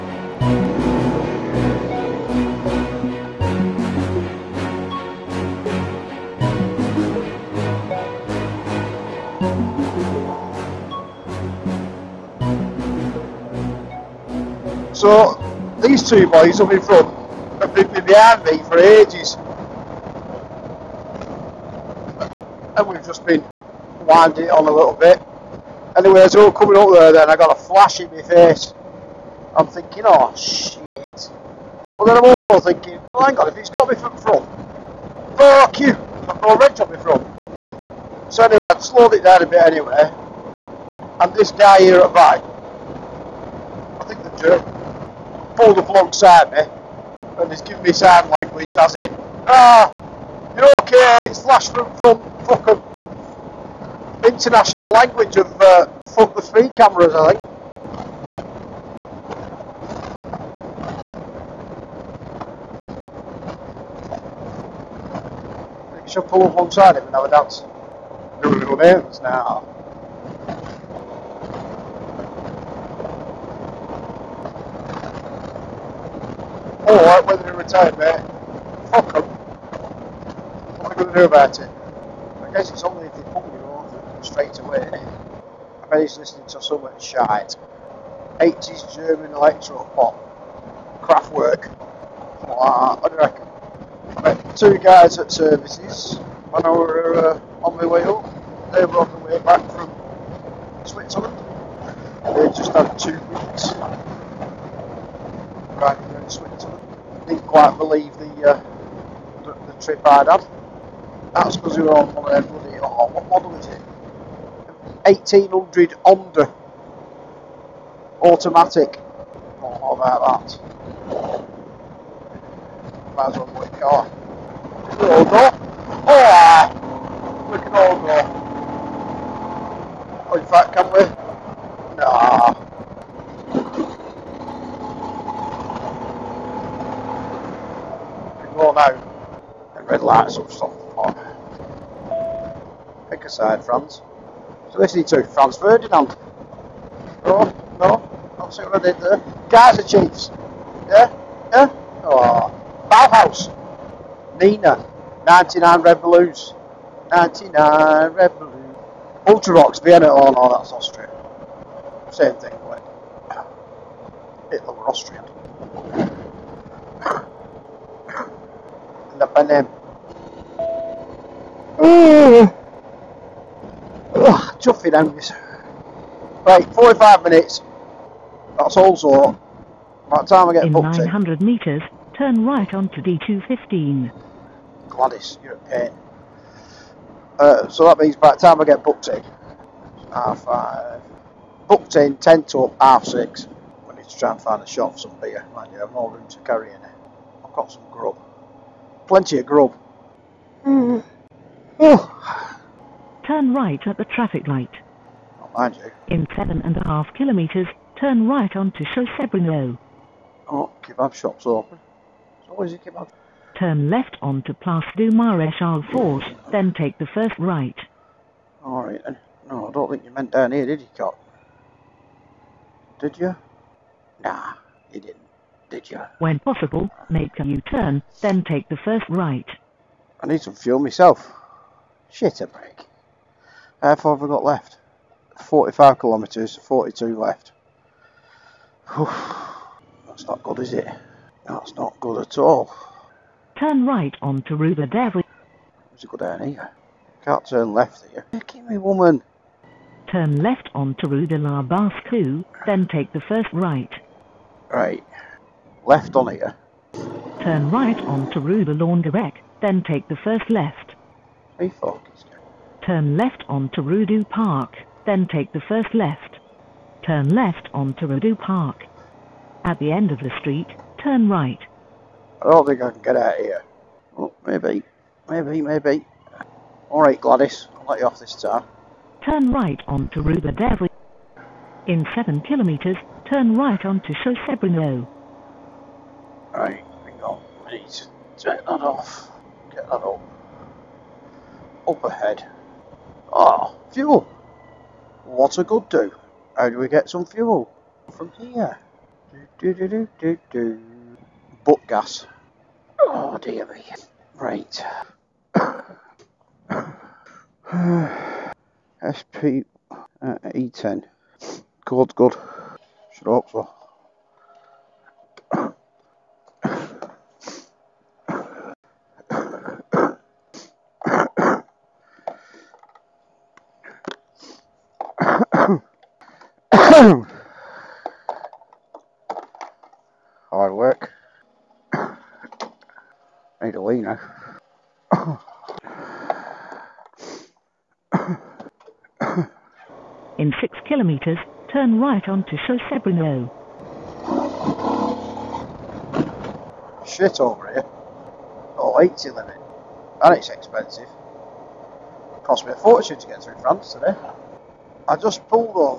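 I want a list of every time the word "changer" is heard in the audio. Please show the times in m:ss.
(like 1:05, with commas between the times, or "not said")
not said.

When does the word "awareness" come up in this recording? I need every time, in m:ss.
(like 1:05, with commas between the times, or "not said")
not said.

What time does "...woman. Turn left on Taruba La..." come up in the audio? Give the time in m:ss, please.
4:08.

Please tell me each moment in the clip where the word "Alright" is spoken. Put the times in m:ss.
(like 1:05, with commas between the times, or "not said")
3:38, 4:36.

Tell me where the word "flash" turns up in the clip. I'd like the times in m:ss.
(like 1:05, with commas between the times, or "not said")
0:27, 0:51.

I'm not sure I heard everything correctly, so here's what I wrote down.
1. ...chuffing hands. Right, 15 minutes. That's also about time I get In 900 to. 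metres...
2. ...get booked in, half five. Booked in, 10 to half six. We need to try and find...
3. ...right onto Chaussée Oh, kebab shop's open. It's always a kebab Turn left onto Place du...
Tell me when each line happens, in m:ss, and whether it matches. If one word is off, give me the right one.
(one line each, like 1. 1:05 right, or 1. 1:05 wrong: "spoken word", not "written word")
1. 2:54 wrong: "45", not "15"
2. 3:08 right
3. 3:28 right.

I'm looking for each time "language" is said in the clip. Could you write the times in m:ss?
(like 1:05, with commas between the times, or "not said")
0:48, 0:54.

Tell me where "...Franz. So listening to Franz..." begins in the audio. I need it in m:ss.
2:23.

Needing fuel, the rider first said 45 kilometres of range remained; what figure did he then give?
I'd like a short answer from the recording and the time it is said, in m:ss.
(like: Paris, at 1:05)
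42, at 3:56.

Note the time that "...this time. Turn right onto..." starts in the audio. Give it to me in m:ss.
4:38.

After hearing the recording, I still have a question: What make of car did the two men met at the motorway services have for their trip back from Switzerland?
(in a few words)
Honda.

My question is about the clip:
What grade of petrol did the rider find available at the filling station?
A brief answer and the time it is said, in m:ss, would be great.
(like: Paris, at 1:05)
E10, at 5:10.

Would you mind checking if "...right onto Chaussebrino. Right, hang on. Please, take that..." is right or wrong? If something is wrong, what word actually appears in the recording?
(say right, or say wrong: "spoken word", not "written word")
right.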